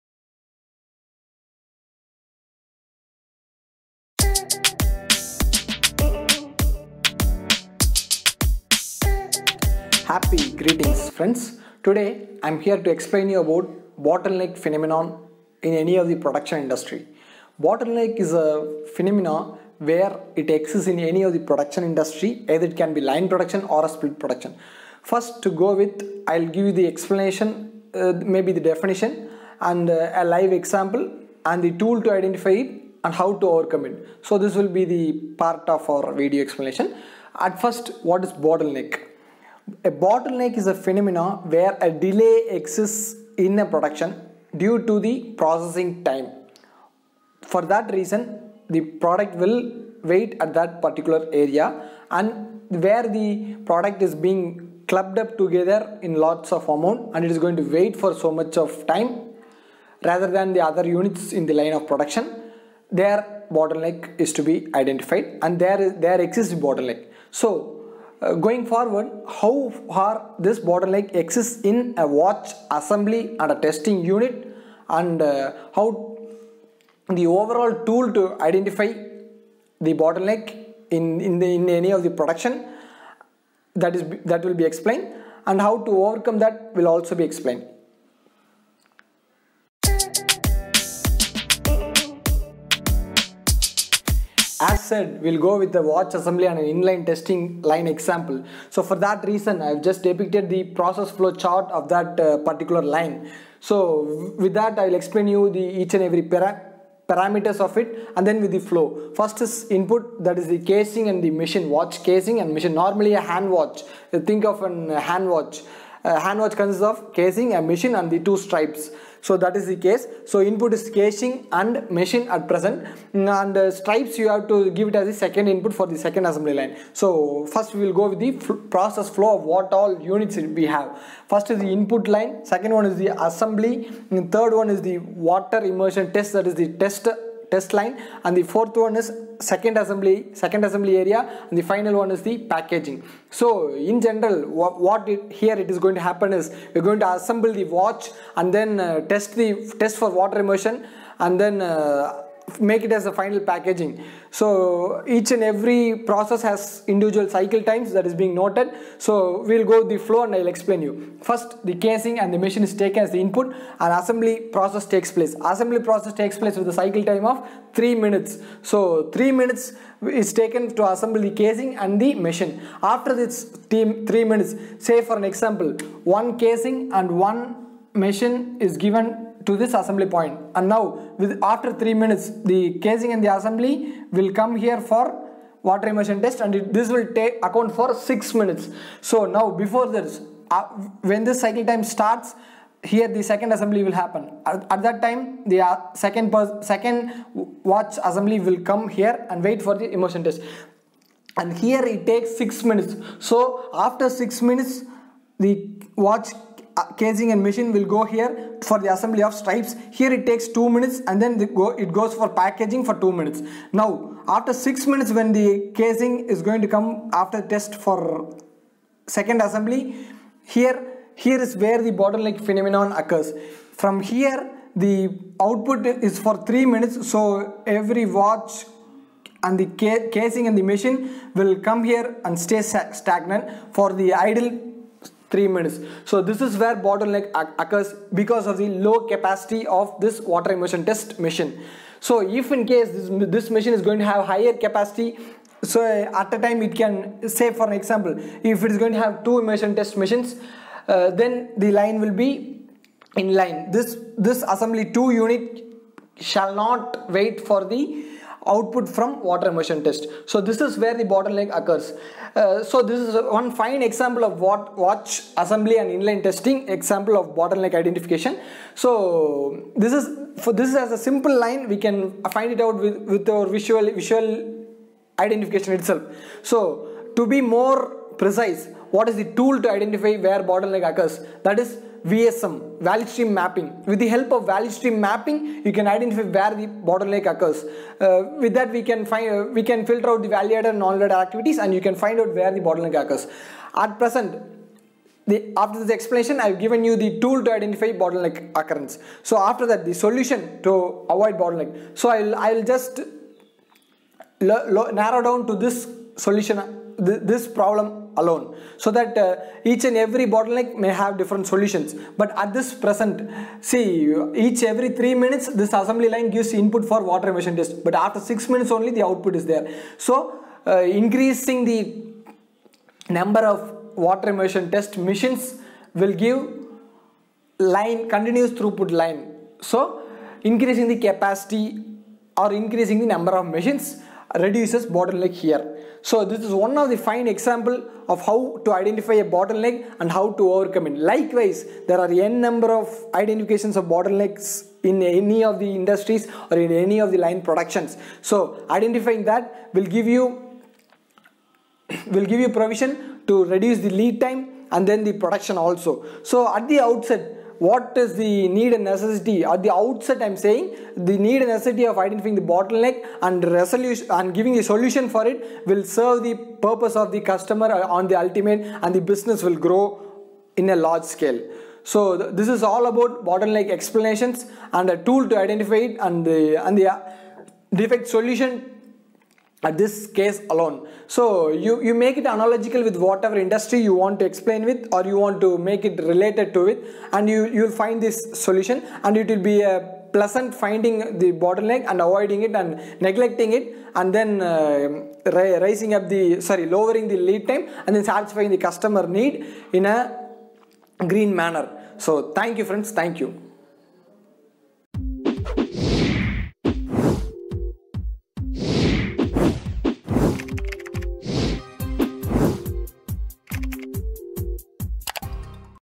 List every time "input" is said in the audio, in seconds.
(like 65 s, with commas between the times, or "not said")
109 s, 120 s, 125 s, 131 s, 163 s, 316 s.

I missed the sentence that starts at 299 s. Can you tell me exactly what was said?
So after that, the solution to avoid bottleneck.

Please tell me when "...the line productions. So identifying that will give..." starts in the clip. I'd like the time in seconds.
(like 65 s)
347 s.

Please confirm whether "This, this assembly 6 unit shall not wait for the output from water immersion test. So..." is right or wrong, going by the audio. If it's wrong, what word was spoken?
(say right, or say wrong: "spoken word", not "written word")
wrong: "2", not "6".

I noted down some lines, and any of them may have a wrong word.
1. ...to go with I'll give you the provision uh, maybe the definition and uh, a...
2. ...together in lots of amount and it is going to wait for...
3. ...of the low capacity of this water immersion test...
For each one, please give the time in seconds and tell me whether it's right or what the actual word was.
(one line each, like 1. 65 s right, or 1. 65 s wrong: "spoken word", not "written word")
1. 25 s wrong: "explanation", not "provision"
2. 55 s right
3. 238 s right.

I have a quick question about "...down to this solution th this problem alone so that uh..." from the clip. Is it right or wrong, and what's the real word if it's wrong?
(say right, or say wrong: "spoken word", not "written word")
right.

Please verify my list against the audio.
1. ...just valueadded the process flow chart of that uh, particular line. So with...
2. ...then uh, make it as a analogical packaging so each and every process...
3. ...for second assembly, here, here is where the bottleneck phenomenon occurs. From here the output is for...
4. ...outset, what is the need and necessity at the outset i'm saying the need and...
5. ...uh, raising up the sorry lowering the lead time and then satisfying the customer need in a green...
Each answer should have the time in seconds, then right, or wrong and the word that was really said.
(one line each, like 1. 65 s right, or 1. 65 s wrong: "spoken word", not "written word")
1. 99 s wrong: "depicted", not "valueadded"
2. 151 s wrong: "final", not "analogical"
3. 217 s right
4. 356 s right
5. 394 s right.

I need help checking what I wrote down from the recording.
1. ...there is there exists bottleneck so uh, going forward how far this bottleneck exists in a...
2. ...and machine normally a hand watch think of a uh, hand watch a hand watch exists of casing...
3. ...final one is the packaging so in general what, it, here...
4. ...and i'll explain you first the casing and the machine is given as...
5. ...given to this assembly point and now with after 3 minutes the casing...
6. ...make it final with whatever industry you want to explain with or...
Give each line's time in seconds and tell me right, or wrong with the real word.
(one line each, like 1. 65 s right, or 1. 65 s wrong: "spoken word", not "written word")
1. 65 s right
2. 112 s wrong: "consists", not "exists"
3. 141 s right
4. 160 s wrong: "taken", not "given"
5. 178 s right
6. 382 s wrong: "analogical", not "final".